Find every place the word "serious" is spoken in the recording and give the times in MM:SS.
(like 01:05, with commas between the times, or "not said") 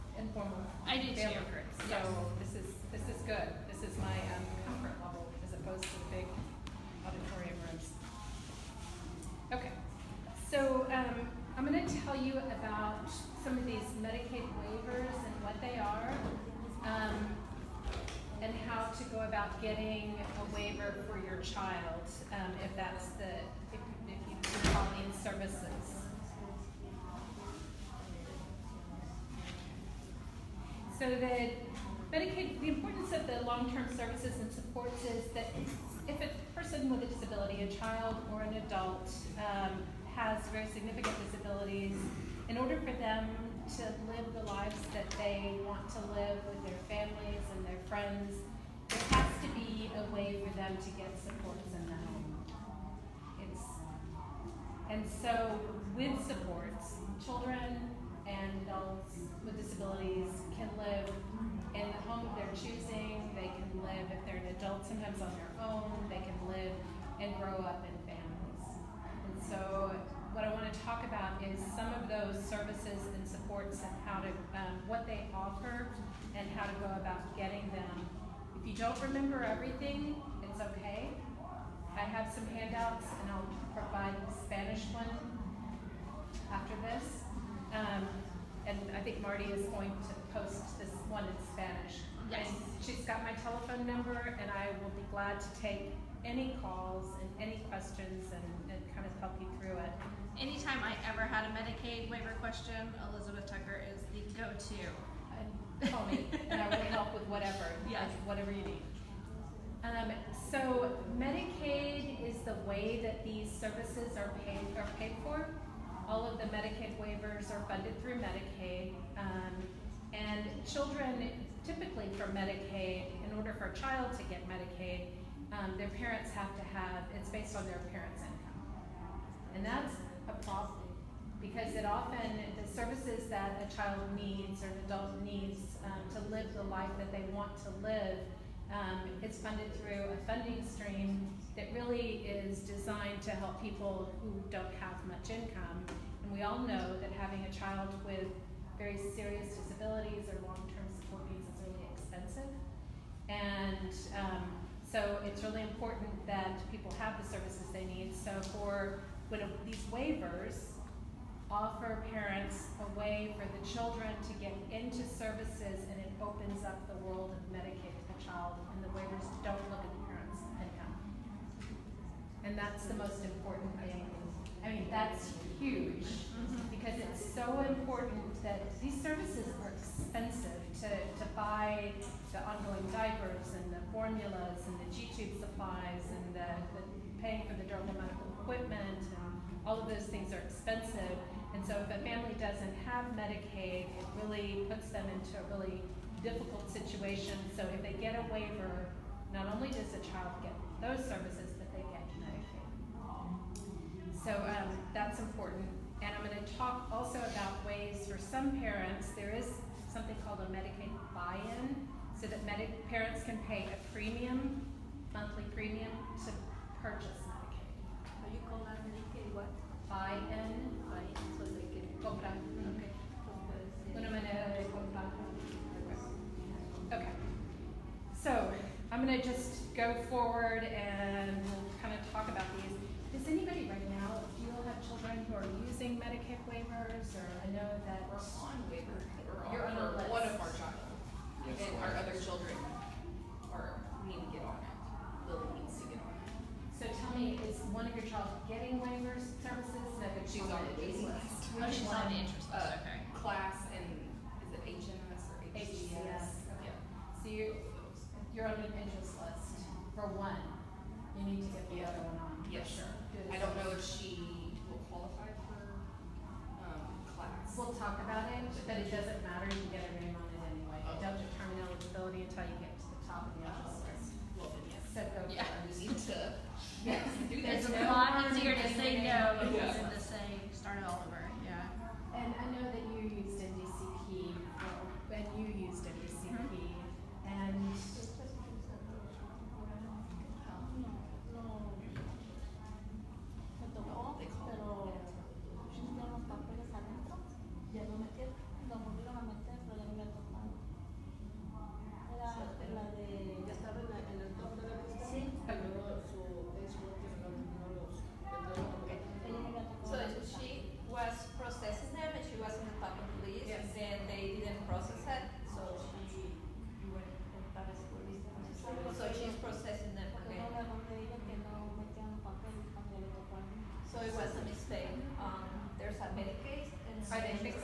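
02:29.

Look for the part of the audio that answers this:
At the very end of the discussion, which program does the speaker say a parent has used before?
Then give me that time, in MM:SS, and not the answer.
04:43.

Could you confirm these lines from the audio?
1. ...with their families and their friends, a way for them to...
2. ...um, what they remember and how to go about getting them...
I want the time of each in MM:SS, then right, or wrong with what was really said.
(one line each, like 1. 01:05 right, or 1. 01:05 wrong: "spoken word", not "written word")
1. 00:46 right
2. 01:14 wrong: "offer", not "remember".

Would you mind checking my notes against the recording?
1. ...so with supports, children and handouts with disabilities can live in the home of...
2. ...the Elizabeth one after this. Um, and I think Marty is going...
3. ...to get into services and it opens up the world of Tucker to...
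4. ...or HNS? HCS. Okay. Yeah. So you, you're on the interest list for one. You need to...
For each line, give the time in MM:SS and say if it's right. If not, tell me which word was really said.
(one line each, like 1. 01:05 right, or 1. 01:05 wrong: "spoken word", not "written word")
1. 00:55 wrong: "adults", not "handouts"
2. 01:24 wrong: "Spanish", not "Elizabeth"
3. 02:44 wrong: "Medicaid", not "Tucker"
4. 04:15 wrong: "HCS", not "HNS".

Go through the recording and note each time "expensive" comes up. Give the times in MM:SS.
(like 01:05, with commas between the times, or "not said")
02:31, 02:59, 03:10.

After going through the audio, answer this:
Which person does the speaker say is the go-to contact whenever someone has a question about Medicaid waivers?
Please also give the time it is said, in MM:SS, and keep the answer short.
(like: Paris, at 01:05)
Elizabeth Tucker, at 01:43.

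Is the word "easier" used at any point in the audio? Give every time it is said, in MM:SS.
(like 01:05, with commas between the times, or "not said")
04:38.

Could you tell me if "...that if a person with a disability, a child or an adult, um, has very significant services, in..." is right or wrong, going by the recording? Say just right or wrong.
wrong.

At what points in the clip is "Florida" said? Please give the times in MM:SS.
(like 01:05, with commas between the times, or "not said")
not said.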